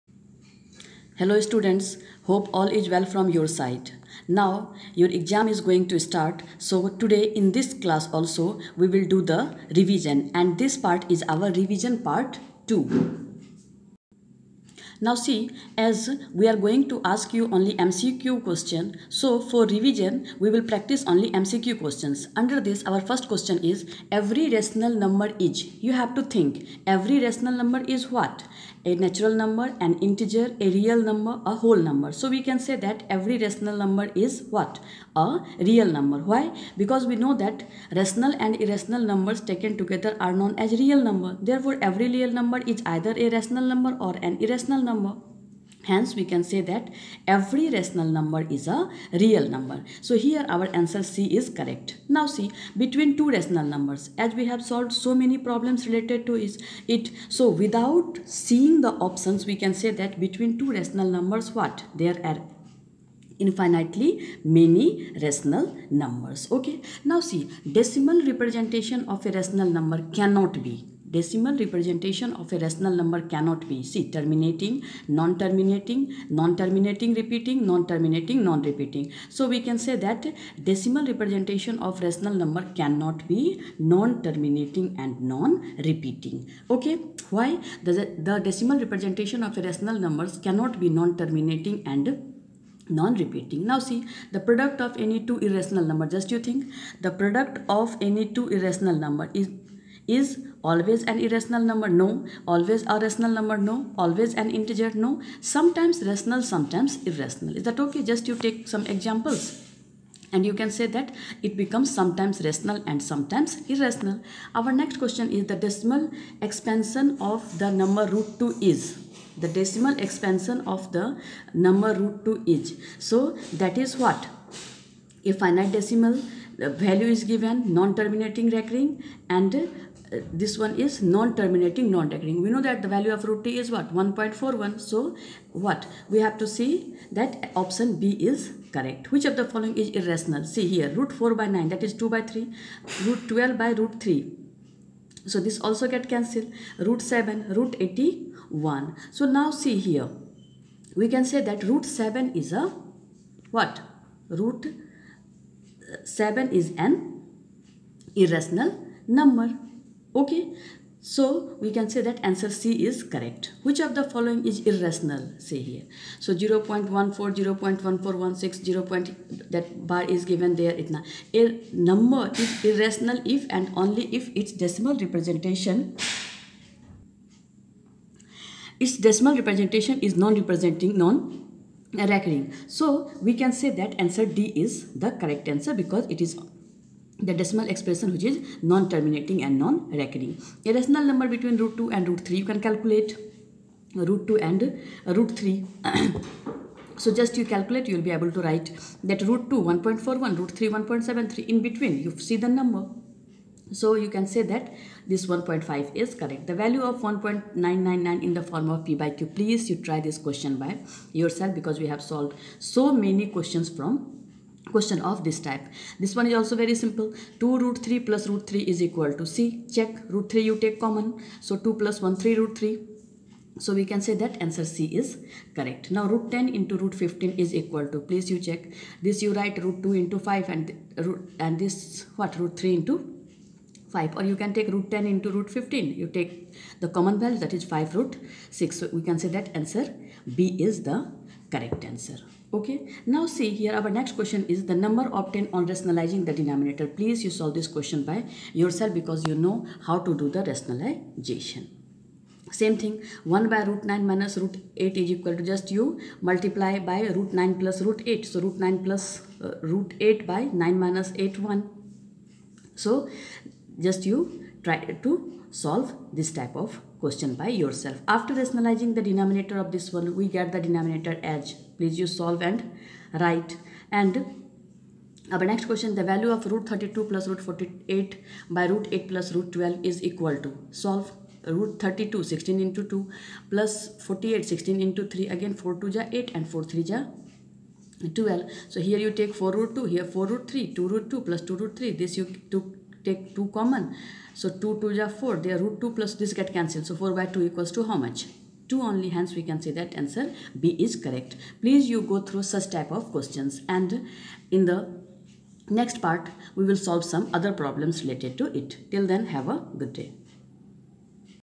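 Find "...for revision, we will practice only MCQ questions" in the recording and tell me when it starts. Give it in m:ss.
0:19.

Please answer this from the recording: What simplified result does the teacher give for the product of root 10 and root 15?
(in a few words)
5 root 6.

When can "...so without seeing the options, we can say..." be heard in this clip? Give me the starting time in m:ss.
0:57.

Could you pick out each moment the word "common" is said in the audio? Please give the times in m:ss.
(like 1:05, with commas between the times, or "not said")
3:40, 3:56, 4:53.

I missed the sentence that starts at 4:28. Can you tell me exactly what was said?
After rationalizing the denominator of this one, we get the denominator as.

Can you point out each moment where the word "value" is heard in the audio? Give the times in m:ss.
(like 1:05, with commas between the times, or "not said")
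2:06, 2:12, 3:26, 3:57, 4:36.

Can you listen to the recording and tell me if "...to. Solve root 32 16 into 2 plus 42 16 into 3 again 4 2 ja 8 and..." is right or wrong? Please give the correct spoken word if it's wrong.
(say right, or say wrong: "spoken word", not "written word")
wrong: "48", not "42".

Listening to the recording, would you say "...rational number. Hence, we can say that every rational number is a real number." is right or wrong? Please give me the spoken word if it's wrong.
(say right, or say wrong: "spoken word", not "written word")
wrong: "irrational", not "rational".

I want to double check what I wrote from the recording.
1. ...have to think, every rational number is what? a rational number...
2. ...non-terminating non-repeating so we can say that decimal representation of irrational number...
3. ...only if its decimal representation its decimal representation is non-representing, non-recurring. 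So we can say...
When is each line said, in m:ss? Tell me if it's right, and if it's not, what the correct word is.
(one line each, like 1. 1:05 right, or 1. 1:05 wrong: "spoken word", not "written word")
1. 0:25 wrong: "natural", not "rational"
2. 1:17 wrong: "rational", not "irrational"
3. 2:53 right.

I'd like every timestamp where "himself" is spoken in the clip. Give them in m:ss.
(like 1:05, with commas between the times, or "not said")
not said.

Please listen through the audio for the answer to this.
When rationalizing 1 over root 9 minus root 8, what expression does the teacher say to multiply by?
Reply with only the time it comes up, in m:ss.
4:17.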